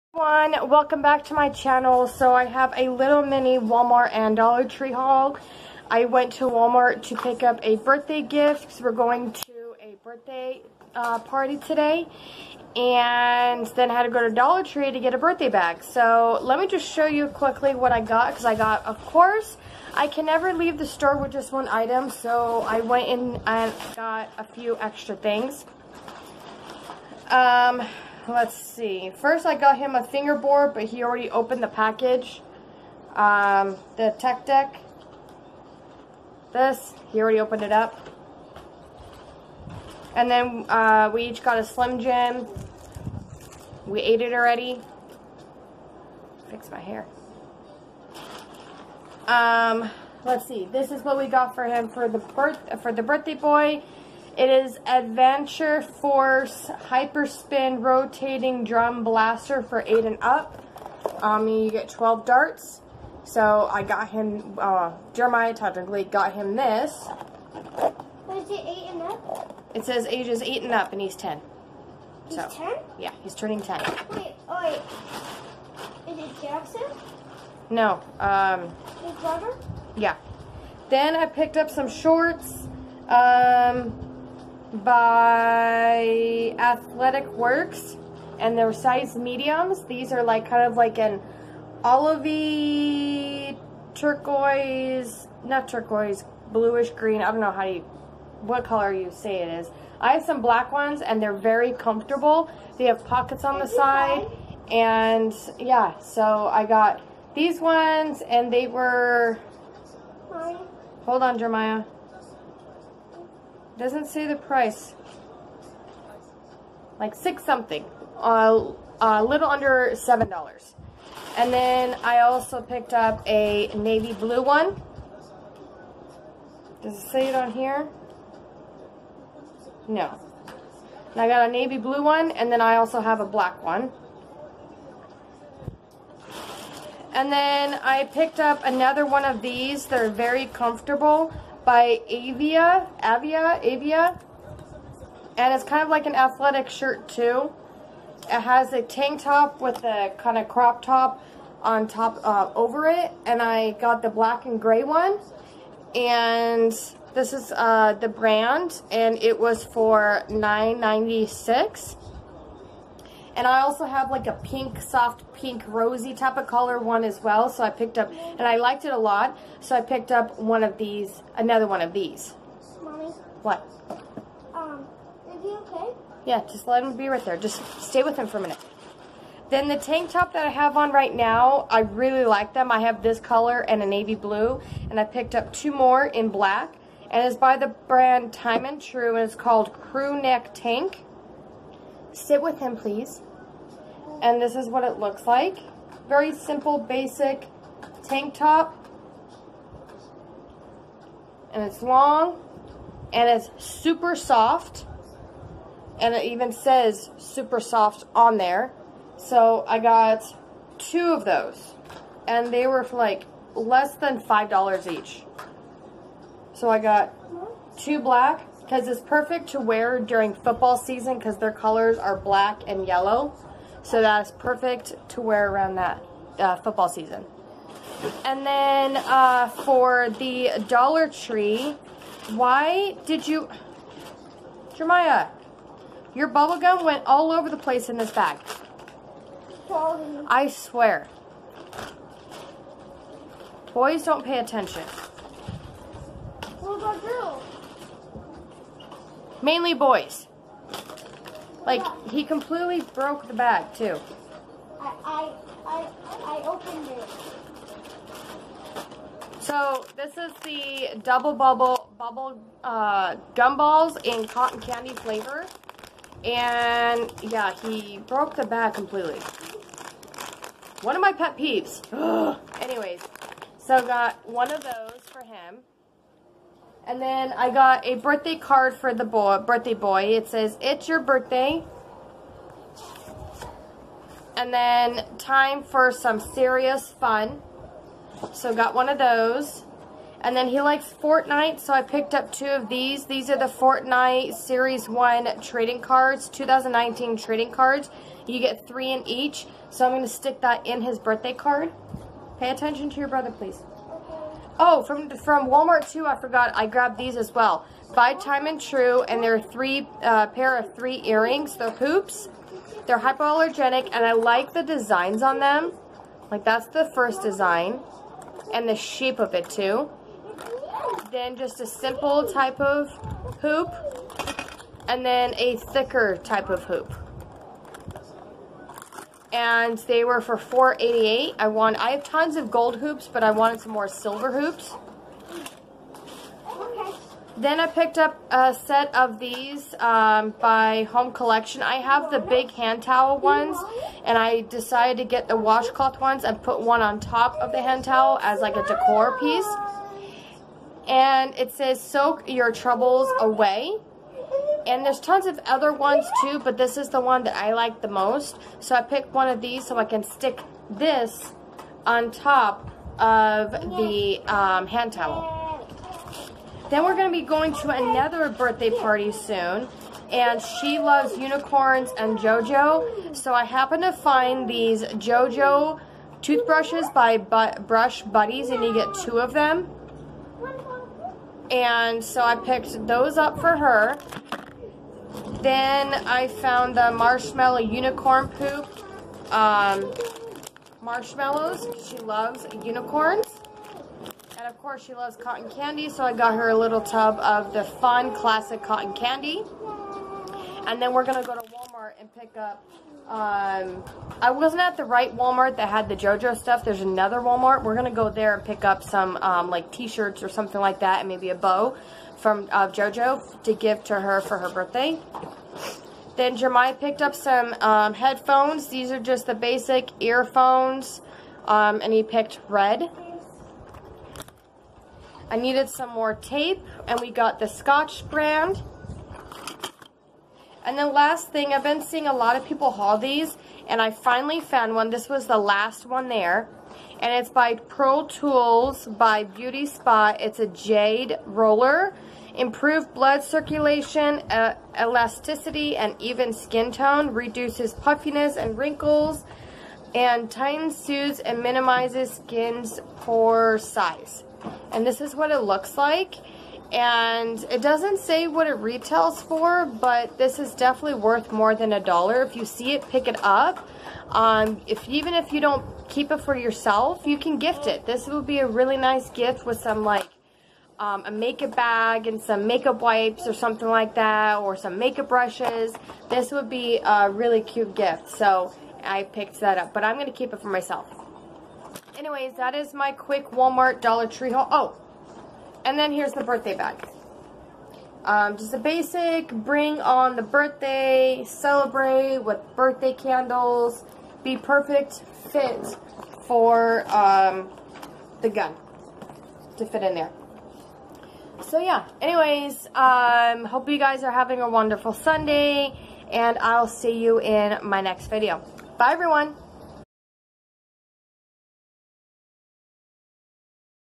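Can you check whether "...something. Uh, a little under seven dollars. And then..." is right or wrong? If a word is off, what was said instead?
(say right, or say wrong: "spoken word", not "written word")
right.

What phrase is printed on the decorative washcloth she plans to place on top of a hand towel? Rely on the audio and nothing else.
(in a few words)
Soak your troubles away.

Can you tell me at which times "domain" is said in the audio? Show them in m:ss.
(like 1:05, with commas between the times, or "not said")
not said.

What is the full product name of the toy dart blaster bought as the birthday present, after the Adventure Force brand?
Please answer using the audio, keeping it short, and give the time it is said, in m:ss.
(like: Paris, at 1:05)
Hyperspin Rotating Drum Blaster, at 0:56.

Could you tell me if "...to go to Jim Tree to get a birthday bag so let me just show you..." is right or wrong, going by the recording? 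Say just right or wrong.
wrong.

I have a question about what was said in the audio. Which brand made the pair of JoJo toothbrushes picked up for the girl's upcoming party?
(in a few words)
Brush Buddies.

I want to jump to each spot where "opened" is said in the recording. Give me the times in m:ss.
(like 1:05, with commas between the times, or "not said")
0:31, 0:37, 4:16.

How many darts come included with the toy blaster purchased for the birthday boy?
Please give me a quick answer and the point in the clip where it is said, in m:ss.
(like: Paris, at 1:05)
12, at 1:01.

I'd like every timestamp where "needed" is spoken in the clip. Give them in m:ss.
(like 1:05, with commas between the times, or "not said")
7:05.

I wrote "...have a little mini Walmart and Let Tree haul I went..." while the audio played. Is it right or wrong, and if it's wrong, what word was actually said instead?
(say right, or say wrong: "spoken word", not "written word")
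wrong: "Dollar", not "Let".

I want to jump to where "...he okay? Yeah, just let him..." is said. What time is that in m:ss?
2:55.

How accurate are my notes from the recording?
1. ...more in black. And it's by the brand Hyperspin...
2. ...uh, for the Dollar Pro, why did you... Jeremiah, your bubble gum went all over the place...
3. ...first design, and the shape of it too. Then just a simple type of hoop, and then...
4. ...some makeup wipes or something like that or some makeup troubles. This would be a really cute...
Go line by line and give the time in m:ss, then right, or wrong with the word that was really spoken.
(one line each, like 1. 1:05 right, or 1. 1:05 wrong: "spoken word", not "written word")
1. 3:05 wrong: "Time", not "Hyperspin"
2. 3:48 wrong: "Tree", not "Pro"
3. 5:16 right
4. 7:52 wrong: "brushes", not "troubles".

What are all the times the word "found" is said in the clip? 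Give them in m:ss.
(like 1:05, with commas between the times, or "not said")
6:26, 7:14.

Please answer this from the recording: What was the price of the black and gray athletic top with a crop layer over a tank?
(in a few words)
$9.96.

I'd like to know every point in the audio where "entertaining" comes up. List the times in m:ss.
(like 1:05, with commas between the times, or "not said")
not said.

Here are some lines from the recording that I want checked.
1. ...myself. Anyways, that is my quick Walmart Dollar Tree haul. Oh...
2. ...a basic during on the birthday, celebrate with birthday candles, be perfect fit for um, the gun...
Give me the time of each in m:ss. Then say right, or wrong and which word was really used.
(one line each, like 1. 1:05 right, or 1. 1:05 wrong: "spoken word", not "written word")
1. 8:00 right
2. 8:08 wrong: "bring", not "during".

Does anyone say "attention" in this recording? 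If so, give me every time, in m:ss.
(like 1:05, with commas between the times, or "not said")
4:04, 5:02.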